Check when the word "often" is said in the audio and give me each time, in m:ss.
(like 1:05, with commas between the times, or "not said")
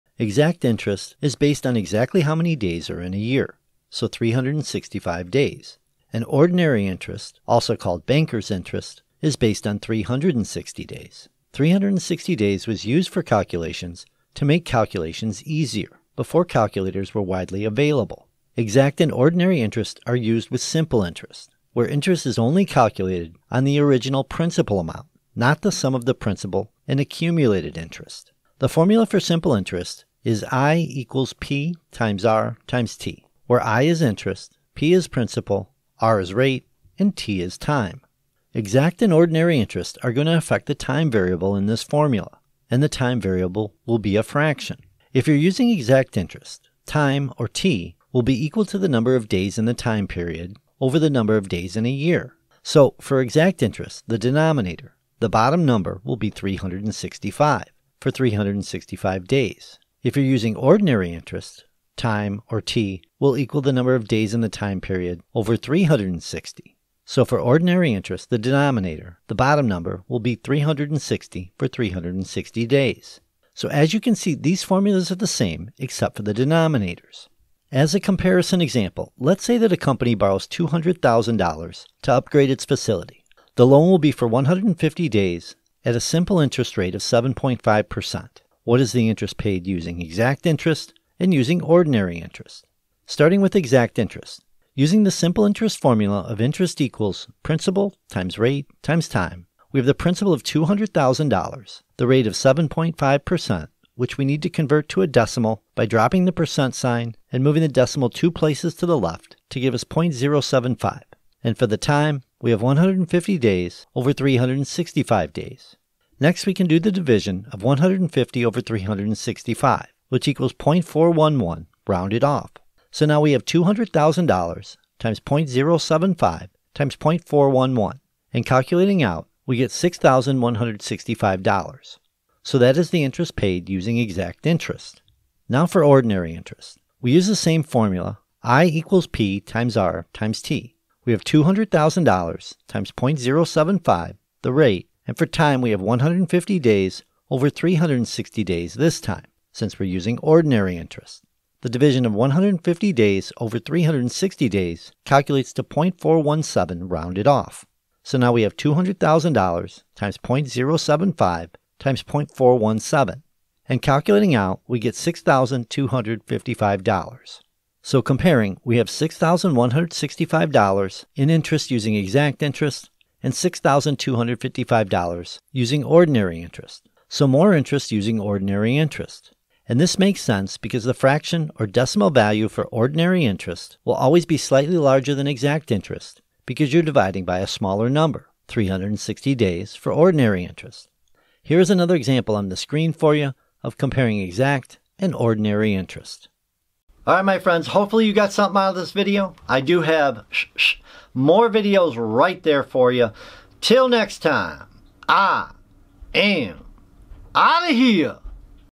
not said.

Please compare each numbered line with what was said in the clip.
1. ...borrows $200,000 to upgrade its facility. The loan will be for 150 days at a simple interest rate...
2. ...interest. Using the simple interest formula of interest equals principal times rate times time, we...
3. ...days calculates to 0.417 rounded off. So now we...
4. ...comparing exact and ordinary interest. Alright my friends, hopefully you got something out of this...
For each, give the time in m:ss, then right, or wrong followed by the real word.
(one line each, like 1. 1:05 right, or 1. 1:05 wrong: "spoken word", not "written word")
1. 1:20 right
2. 1:33 right
3. 2:34 right
4. 3:13 right.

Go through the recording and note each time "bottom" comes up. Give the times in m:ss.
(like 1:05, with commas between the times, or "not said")
0:55, 1:09.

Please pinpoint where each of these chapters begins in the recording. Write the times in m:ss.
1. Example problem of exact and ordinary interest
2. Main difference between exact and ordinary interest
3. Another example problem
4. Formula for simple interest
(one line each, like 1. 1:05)
1. 1:16
2. 0:52
3. 3:11
4. 0:28.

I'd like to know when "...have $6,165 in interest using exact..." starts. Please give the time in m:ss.
2:48.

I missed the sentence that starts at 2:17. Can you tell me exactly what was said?
We use the same formula, I equals P times R times T.